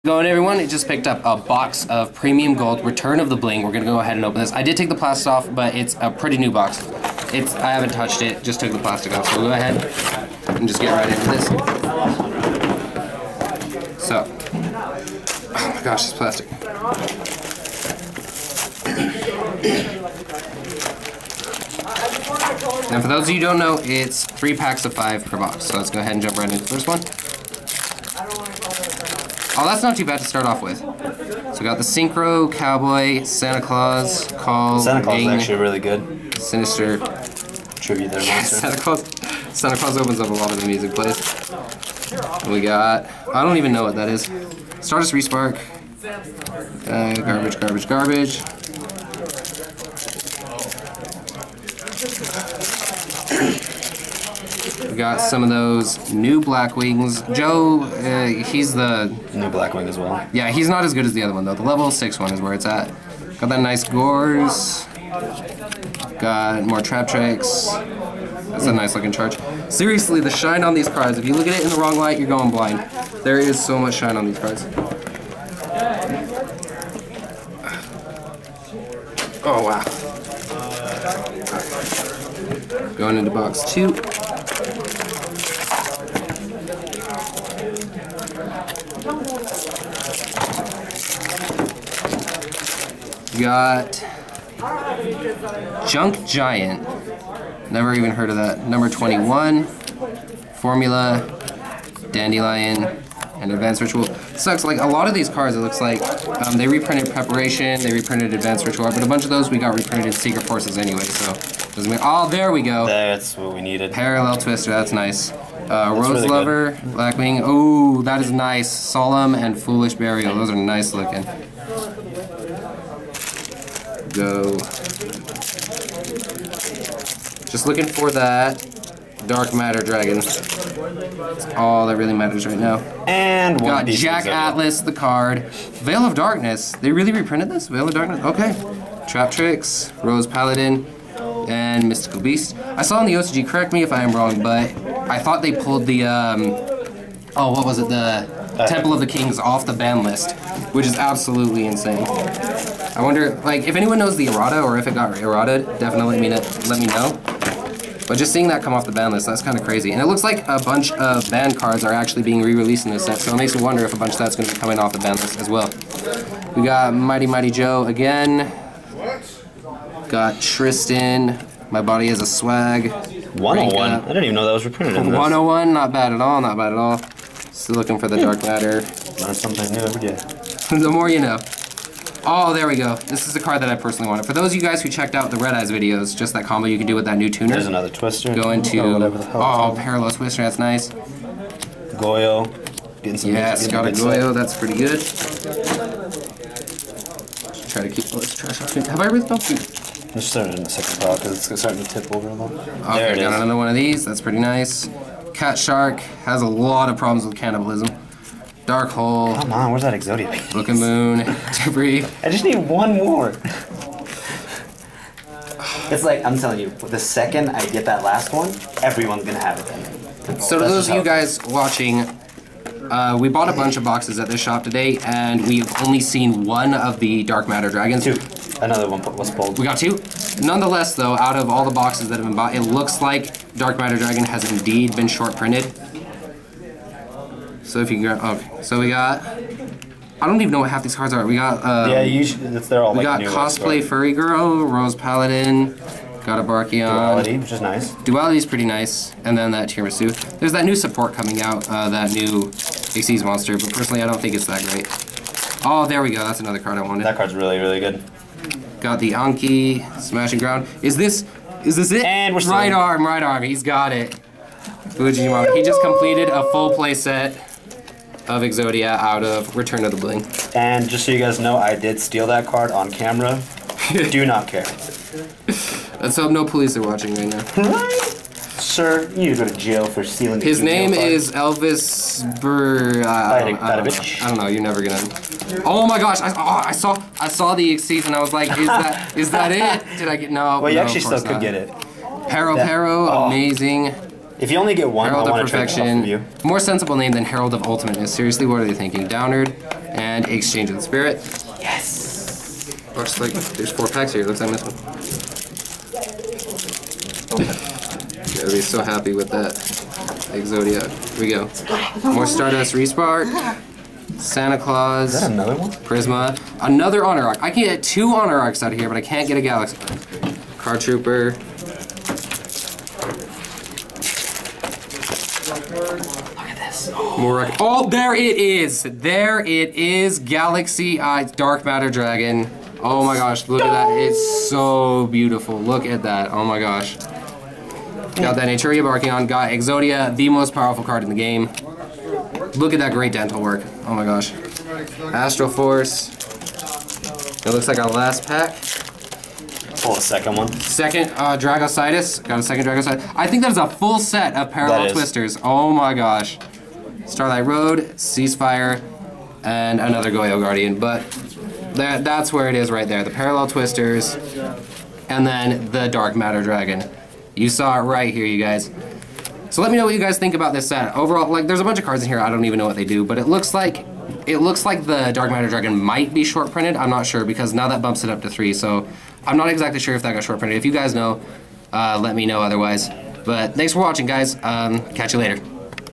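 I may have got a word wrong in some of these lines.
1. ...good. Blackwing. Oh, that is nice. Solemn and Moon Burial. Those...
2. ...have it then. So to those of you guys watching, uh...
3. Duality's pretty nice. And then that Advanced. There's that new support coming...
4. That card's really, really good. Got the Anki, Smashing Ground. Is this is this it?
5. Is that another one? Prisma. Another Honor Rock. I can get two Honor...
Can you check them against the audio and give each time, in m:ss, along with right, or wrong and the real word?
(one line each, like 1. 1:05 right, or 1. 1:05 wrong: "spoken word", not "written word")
1. 1:56 wrong: "Foolish", not "Moon"
2. 3:39 right
3. 4:08 wrong: "Tiramisu", not "Advanced"
4. 4:17 right
5. 5:15 right.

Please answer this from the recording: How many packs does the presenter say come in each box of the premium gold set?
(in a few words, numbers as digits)
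3.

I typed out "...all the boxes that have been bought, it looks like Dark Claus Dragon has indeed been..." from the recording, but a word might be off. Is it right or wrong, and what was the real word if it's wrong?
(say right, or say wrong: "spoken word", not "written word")
wrong: "Matter", not "Claus".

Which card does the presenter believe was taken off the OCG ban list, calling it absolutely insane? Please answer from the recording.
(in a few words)
Temple of the Kings.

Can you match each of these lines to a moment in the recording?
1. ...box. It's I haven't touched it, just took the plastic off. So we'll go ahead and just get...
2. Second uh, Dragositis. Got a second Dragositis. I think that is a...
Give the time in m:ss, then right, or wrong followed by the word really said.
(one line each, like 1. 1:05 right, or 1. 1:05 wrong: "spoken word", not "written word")
1. 0:06 right
2. 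5:50 right.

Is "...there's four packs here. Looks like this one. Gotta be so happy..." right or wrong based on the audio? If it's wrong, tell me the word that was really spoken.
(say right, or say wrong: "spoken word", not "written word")
right.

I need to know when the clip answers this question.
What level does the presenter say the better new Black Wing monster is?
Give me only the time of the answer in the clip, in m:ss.
1:01.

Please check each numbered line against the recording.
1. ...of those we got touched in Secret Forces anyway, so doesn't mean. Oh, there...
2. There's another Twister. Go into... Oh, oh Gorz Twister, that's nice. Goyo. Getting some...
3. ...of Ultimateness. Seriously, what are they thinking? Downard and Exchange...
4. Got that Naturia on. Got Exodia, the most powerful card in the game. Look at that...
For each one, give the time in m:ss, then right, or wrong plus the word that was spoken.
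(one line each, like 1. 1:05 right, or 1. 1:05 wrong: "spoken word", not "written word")
1. 1:49 wrong: "reprinted", not "touched"
2. 3:07 wrong: "Parallel", not "Gorz"
3. 4:57 right
4. 5:38 right.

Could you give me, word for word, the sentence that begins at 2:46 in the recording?
We got Mighty Mighty Joe again.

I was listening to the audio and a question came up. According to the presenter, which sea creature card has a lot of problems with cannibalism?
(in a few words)
Cat Shark.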